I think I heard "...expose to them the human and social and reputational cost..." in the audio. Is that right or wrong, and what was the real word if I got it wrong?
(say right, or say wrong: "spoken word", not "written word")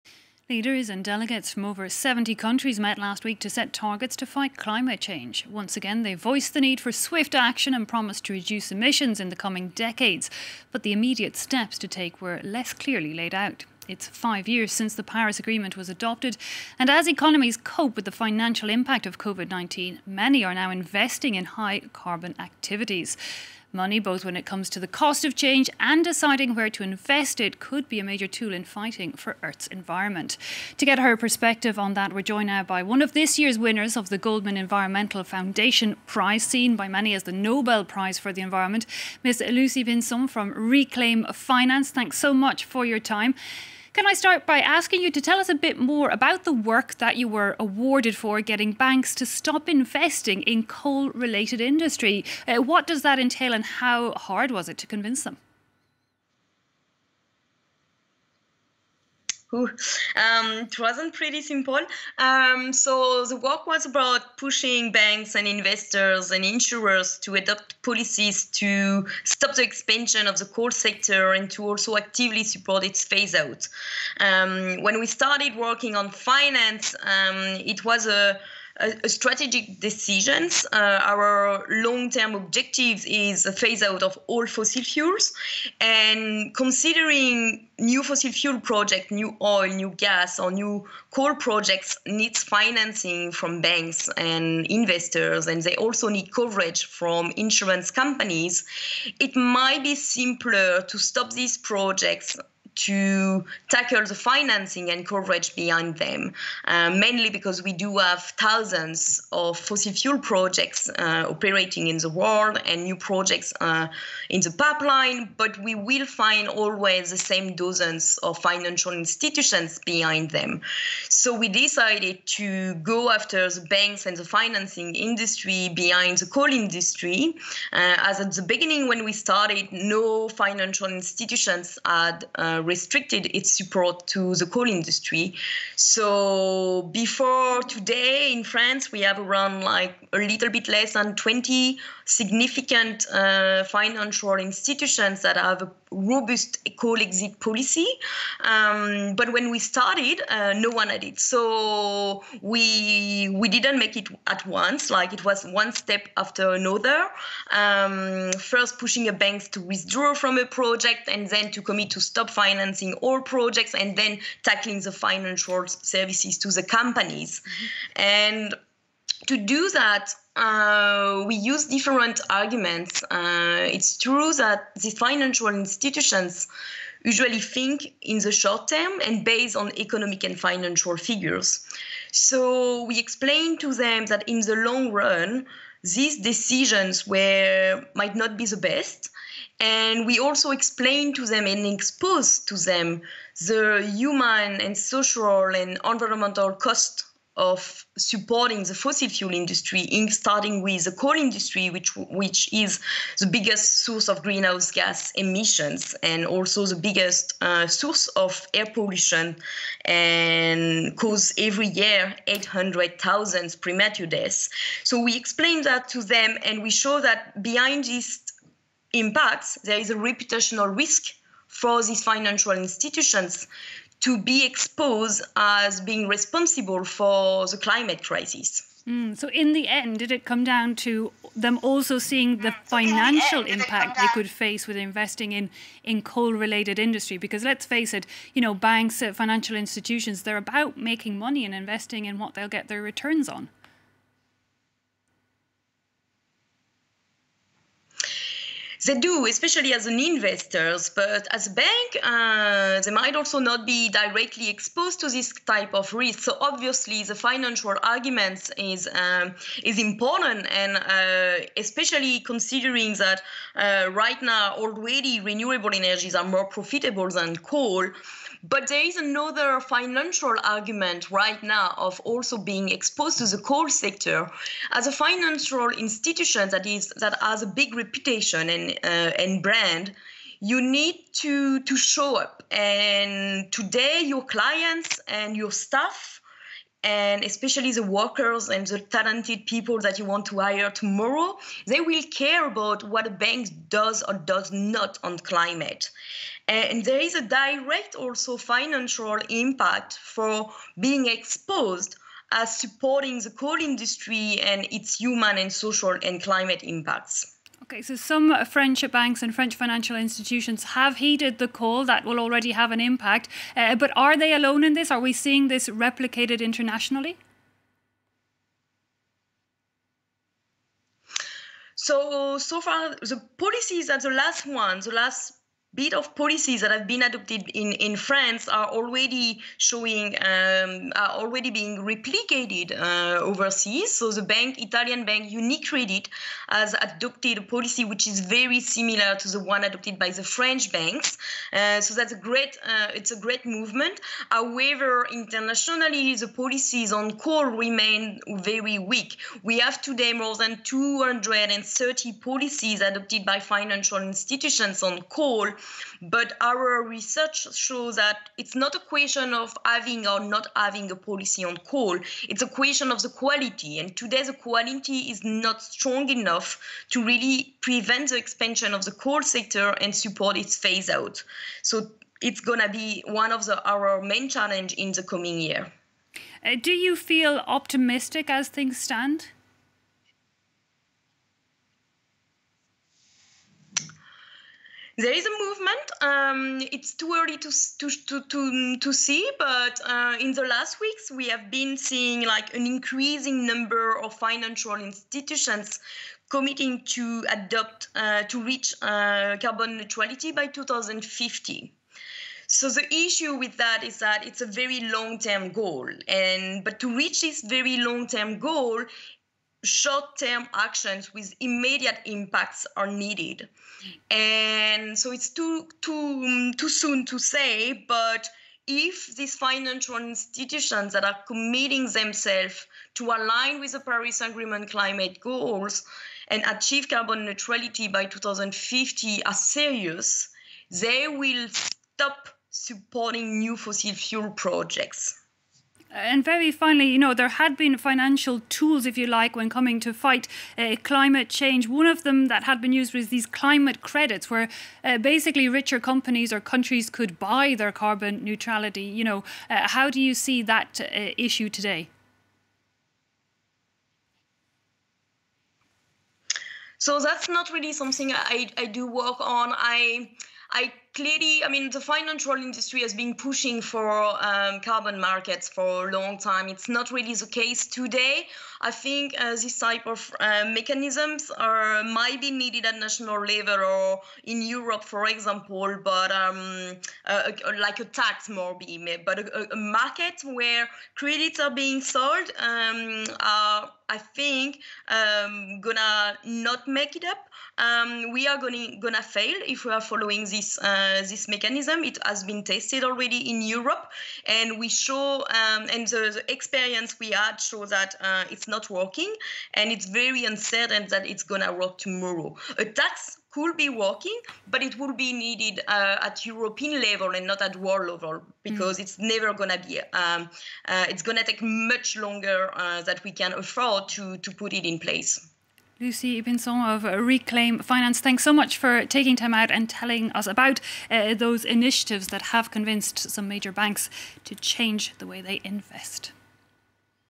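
wrong: "environmental", not "reputational".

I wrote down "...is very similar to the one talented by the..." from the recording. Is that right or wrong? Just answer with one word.
wrong.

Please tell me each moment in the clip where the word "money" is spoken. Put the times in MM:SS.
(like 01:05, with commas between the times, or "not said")
00:23, 04:01.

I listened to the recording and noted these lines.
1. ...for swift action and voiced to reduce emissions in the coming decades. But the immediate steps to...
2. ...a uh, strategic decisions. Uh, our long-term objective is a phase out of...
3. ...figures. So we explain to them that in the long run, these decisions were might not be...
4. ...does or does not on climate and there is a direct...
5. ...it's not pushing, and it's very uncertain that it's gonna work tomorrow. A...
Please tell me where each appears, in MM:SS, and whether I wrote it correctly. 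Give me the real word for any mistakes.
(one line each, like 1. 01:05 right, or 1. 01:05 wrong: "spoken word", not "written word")
1. 00:06 wrong: "promised", not "voiced"
2. 01:18 right
3. 03:00 right
4. 04:53 right
5. 08:18 wrong: "working", not "pushing".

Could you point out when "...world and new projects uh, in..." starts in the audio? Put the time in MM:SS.
01:52.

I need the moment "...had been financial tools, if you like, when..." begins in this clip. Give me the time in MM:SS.
07:17.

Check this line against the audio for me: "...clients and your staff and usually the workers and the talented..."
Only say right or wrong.
wrong.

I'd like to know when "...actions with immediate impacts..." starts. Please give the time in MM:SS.
06:50.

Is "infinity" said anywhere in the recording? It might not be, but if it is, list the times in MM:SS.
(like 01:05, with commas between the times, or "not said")
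not said.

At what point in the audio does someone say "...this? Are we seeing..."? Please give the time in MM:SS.
05:14.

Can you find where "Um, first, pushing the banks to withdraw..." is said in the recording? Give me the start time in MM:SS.
02:37.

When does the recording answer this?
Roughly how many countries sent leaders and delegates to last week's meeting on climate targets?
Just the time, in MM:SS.
00:01.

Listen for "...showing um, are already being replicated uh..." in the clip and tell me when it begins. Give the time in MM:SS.
05:29.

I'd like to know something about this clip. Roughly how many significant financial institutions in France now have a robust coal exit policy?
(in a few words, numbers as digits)
a little less than 20.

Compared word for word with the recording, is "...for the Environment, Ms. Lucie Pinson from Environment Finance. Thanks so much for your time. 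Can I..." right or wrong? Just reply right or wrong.
wrong.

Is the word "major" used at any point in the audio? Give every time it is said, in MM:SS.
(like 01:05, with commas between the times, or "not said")
00:28, 08:43.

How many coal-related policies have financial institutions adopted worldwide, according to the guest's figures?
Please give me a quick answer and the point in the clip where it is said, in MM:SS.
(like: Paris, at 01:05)
more than 230, at 05:50.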